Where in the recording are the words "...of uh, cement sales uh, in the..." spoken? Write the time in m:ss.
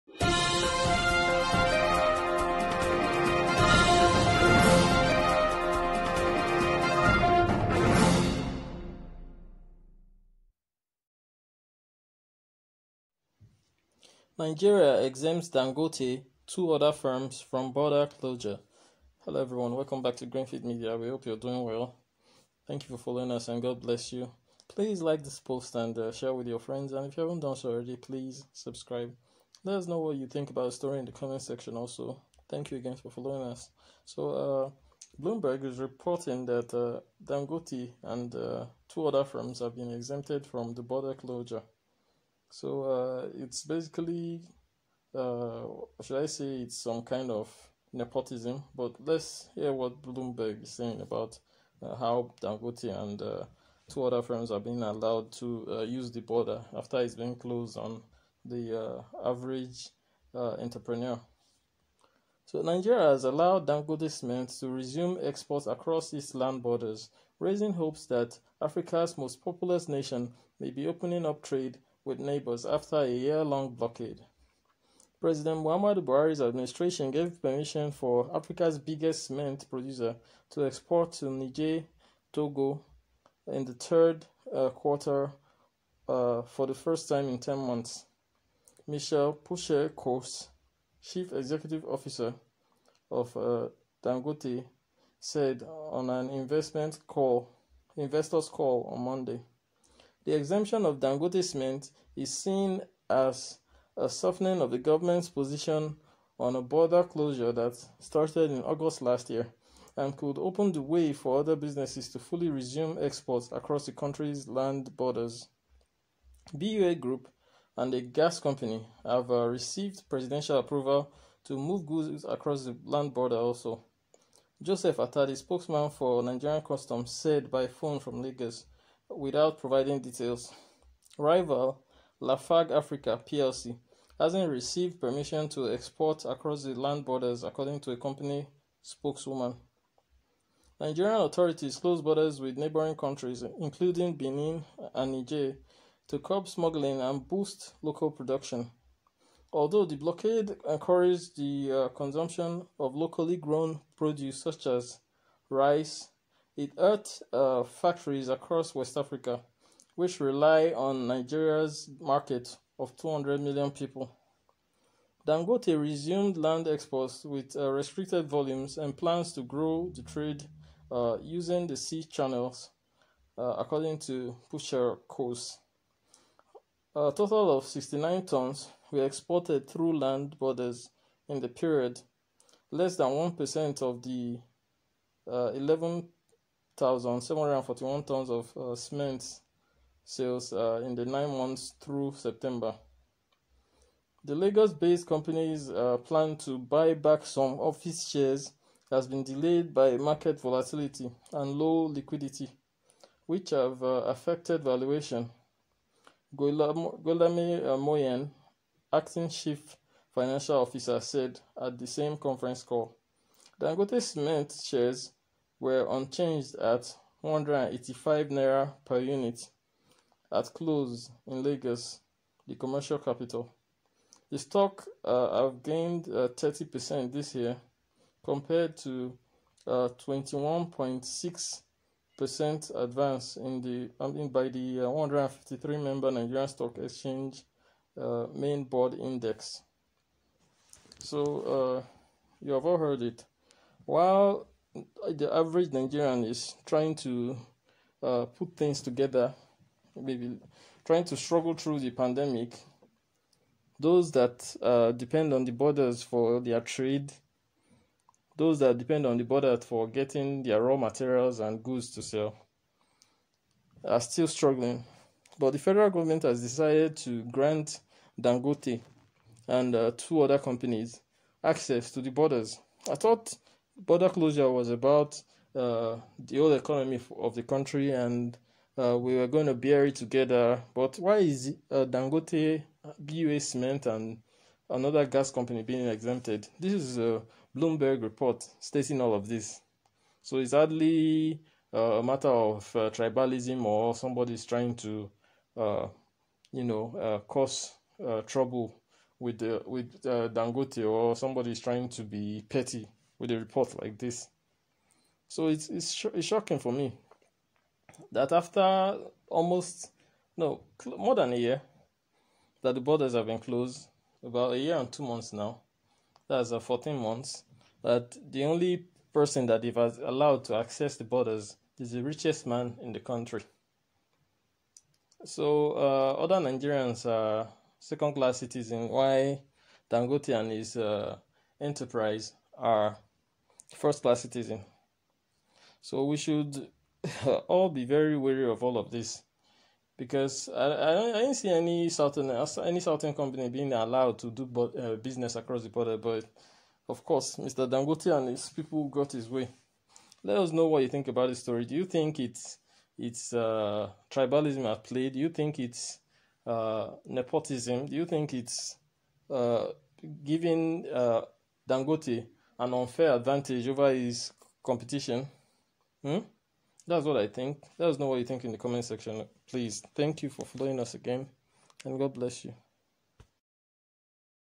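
3:08.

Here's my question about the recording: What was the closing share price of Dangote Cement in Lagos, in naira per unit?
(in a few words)
185 naira.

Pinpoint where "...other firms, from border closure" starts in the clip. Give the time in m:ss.
0:16.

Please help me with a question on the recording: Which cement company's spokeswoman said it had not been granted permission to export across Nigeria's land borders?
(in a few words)
Lafarge Africa.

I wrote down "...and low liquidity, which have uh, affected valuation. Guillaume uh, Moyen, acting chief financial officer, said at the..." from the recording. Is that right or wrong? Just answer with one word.
right.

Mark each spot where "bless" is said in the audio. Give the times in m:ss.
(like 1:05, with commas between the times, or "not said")
0:23, 6:12.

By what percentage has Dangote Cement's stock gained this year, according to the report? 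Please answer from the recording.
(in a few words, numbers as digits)
30%.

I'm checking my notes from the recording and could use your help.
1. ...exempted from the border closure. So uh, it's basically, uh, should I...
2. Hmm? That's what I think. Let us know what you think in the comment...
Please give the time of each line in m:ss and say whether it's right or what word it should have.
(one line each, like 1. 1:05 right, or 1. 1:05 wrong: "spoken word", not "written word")
1. 0:39 right
2. 6:06 right.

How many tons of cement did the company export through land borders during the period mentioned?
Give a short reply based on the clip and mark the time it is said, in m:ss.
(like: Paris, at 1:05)
69 tons, at 2:57.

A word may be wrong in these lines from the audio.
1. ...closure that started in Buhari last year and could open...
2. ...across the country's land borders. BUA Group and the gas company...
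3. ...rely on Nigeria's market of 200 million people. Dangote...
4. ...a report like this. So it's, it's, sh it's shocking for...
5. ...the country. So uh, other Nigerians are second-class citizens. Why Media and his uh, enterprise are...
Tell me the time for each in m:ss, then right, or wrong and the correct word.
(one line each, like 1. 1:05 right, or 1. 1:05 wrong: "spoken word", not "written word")
1. 1:47 wrong: "August", not "Buhari"
2. 1:53 right
3. 2:40 right
4. 5:03 right
5. 5:22 wrong: "Dangote", not "Media".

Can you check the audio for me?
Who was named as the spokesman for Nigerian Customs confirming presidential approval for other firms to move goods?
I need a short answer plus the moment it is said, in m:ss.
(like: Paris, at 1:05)
Joseph Atadi, at 2:04.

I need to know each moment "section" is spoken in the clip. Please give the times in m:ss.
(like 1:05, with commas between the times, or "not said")
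0:31, 6:08.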